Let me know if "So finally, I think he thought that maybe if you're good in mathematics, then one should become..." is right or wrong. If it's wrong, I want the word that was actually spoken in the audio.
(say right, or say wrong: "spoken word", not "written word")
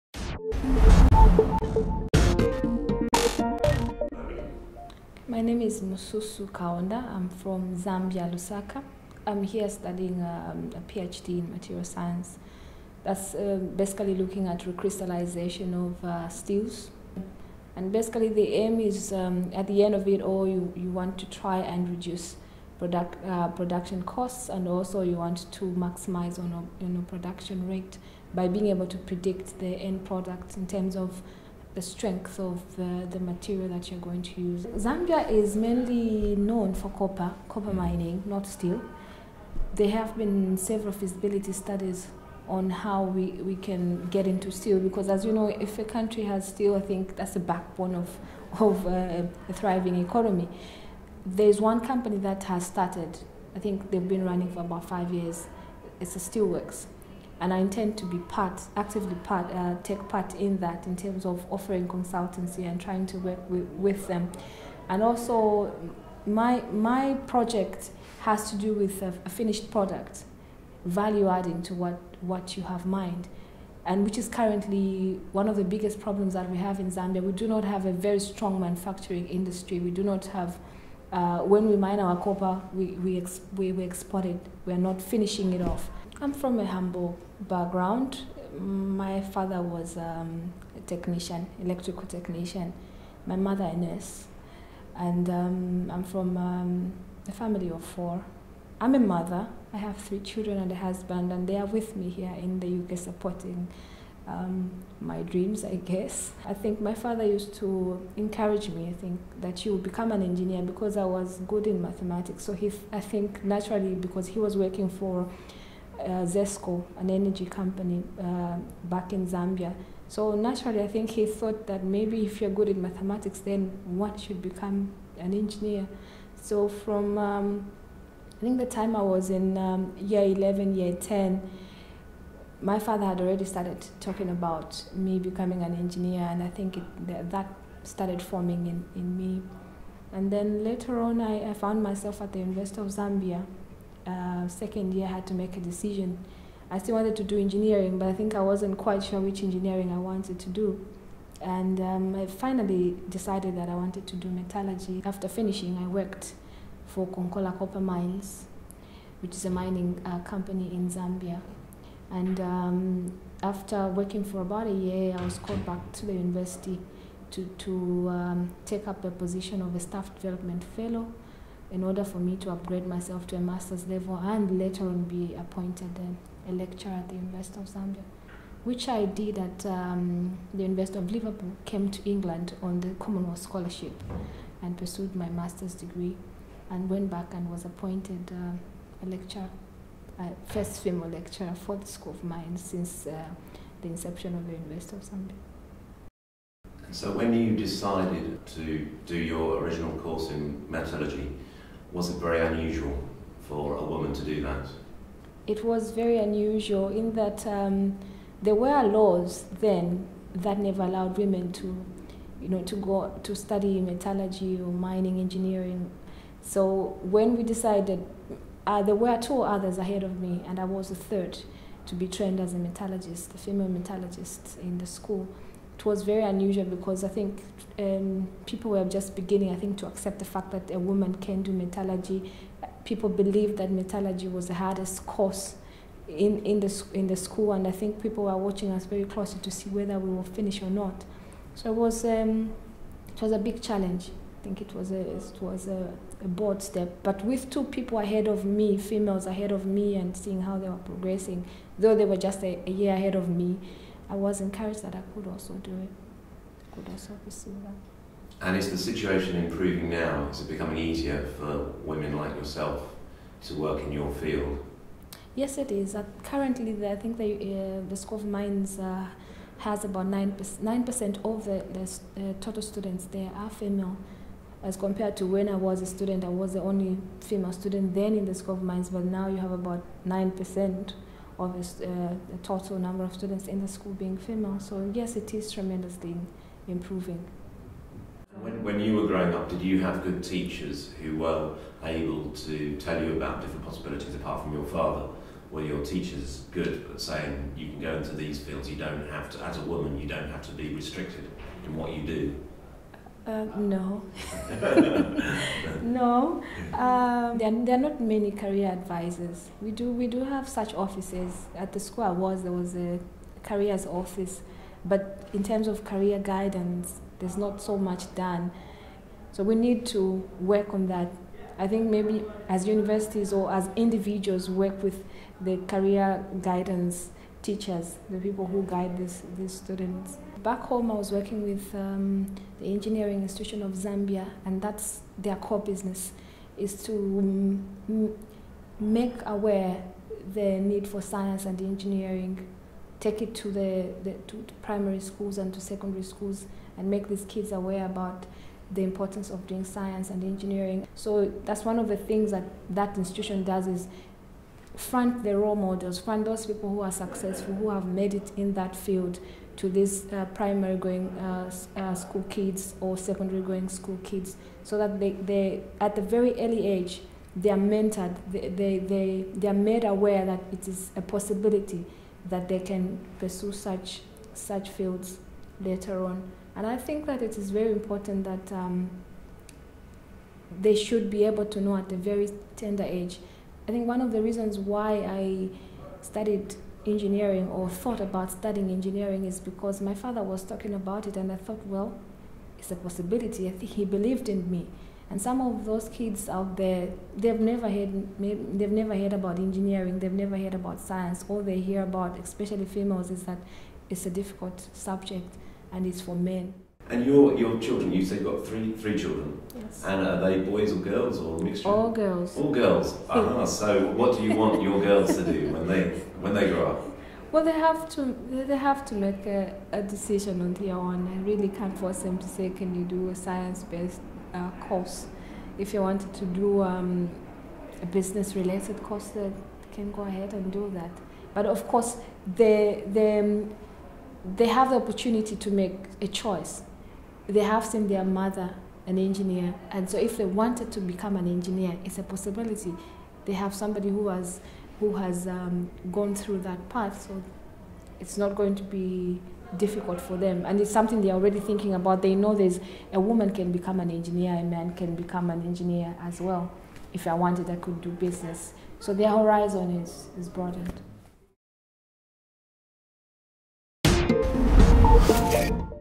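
wrong: "naturally", not "finally".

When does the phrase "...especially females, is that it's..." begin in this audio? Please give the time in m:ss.
6:42.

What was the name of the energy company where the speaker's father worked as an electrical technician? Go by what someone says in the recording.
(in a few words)
ZESCO.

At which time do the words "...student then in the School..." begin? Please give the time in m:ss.
4:37.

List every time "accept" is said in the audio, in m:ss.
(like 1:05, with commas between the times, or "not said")
3:49.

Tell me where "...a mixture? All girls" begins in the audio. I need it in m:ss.
6:51.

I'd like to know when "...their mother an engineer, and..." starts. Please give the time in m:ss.
7:17.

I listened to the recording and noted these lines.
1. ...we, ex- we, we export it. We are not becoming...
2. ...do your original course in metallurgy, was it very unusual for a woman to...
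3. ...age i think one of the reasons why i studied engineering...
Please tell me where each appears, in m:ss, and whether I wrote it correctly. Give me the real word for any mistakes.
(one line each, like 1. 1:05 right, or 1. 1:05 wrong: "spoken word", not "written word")
1. 1:22 wrong: "finishing", not "becoming"
2. 3:19 right
3. 6:22 right.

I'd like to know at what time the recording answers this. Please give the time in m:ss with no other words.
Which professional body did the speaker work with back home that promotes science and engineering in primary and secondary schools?
5:32.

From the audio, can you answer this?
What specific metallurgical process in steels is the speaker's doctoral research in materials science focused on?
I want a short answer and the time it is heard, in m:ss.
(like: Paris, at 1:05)
Recrystallization, at 0:14.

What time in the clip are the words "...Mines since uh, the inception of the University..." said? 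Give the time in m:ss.
3:12.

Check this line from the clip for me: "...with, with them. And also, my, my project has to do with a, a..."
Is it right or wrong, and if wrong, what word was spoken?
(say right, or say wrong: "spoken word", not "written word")
right.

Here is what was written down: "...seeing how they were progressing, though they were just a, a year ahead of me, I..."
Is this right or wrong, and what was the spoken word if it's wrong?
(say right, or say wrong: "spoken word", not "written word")
right.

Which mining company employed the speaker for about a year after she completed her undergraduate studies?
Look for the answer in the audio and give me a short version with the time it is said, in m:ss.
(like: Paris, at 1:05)
Konkola Copper Mines, at 2:37.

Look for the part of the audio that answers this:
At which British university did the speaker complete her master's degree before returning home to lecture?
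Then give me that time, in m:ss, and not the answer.
3:00.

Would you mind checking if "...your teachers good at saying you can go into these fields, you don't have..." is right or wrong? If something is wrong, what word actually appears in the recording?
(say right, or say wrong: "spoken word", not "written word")
right.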